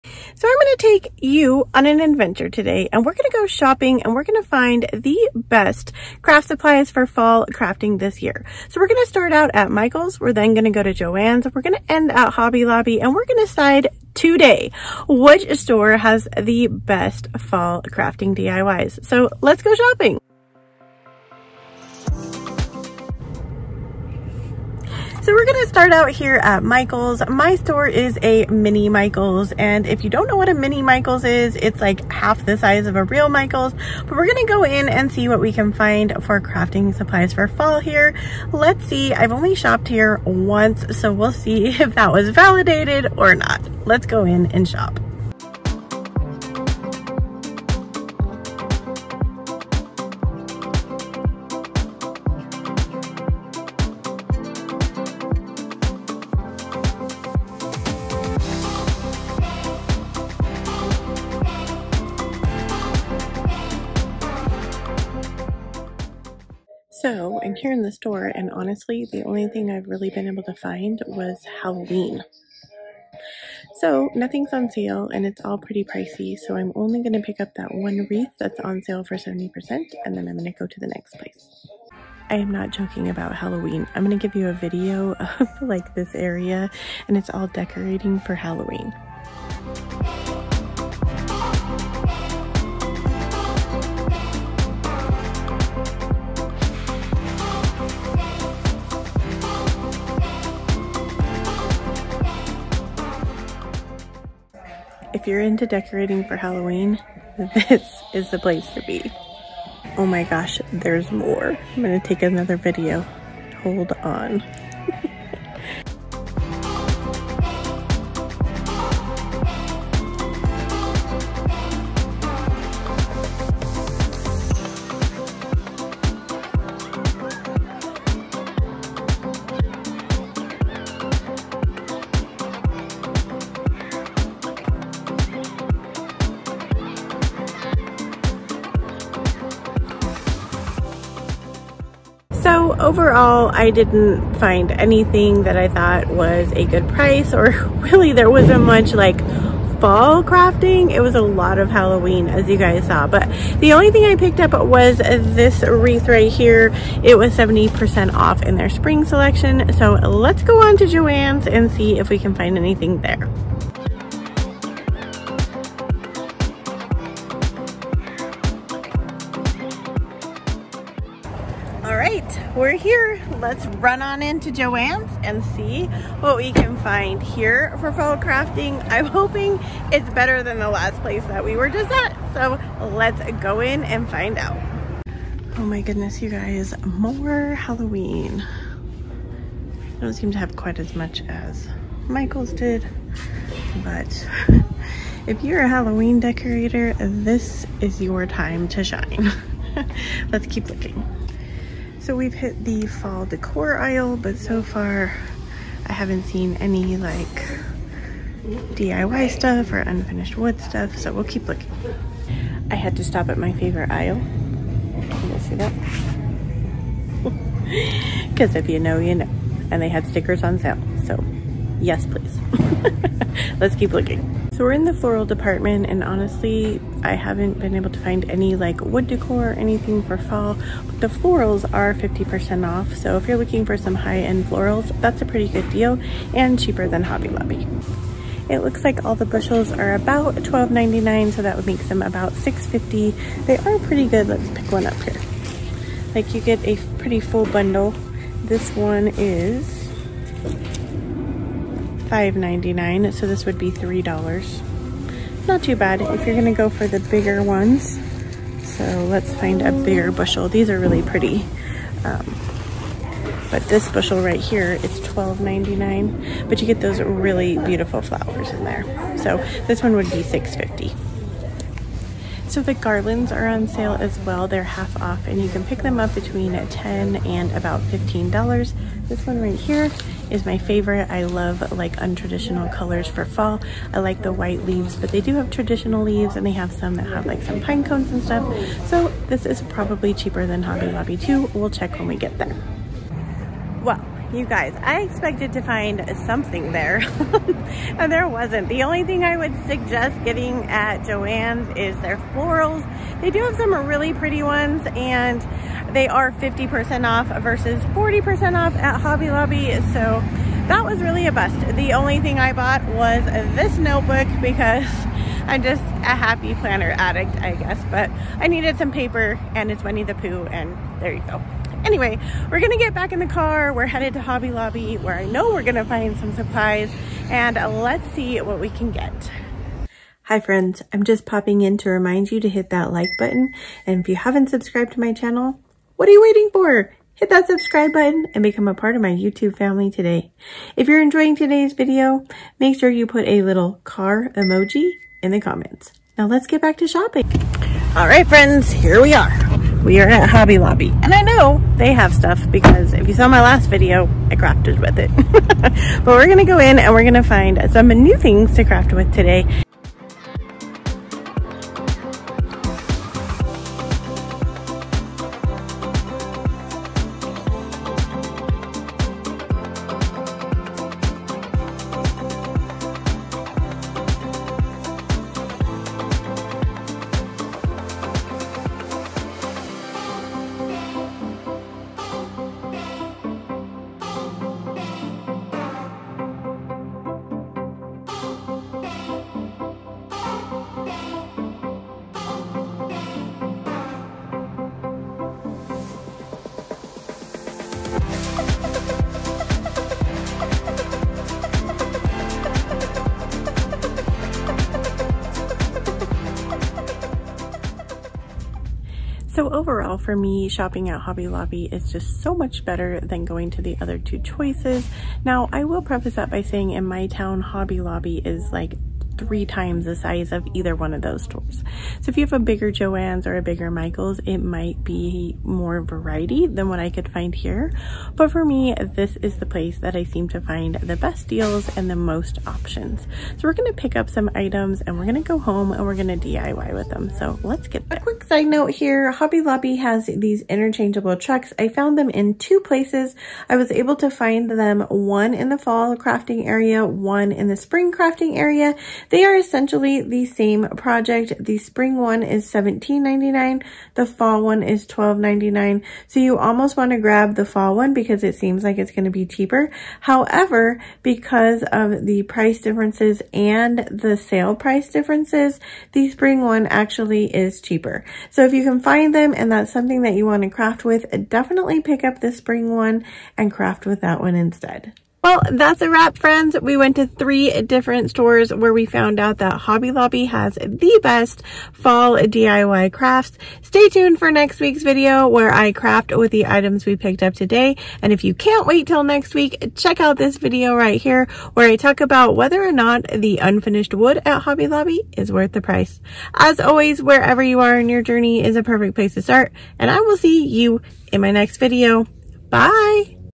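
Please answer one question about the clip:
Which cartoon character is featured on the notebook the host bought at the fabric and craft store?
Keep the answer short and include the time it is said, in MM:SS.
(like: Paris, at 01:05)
Winnie the Pooh, at 05:19.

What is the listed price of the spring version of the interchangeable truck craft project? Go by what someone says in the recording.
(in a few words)
$17.99.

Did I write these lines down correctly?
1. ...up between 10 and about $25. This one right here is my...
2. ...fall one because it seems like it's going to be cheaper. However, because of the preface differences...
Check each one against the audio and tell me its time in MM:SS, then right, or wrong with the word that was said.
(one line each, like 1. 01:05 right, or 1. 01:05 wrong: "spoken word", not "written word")
1. 04:36 wrong: "15", not "25"
2. 07:37 wrong: "price", not "preface".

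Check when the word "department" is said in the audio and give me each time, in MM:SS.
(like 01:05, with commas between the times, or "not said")
03:45.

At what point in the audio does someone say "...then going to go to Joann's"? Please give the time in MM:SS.
00:10.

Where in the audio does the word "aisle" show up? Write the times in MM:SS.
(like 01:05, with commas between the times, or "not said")
03:23, 03:33.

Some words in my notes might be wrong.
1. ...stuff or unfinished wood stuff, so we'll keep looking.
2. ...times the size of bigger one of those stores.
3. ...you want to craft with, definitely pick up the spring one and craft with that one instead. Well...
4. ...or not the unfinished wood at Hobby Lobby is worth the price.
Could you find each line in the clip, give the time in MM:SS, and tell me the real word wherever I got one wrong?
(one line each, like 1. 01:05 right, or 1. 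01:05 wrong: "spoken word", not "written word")
1. 03:29 right
2. 06:59 wrong: "either", not "bigger"
3. 07:50 right
4. 08:12 right.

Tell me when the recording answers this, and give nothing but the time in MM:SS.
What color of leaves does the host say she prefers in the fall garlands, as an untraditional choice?
04:44.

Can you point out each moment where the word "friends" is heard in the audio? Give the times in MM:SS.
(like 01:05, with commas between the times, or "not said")
05:30, 05:48, 07:56.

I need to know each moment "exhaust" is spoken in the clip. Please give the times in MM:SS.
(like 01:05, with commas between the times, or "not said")
not said.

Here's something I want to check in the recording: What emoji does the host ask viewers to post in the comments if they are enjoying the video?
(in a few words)
car emoji.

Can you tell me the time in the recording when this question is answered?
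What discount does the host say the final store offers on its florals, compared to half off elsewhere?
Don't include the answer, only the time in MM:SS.
05:07.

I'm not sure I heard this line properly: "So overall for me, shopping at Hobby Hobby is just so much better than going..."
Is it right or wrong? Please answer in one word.
wrong.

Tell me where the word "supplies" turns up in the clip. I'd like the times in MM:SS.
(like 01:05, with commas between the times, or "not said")
00:06, 00:36, 05:26.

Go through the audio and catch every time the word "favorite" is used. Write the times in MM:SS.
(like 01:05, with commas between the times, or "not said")
03:33, 04:40.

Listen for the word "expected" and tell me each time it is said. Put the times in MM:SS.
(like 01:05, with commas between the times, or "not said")
04:55.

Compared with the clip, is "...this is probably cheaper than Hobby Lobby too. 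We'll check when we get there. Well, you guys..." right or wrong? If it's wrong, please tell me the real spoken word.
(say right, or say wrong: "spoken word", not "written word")
right.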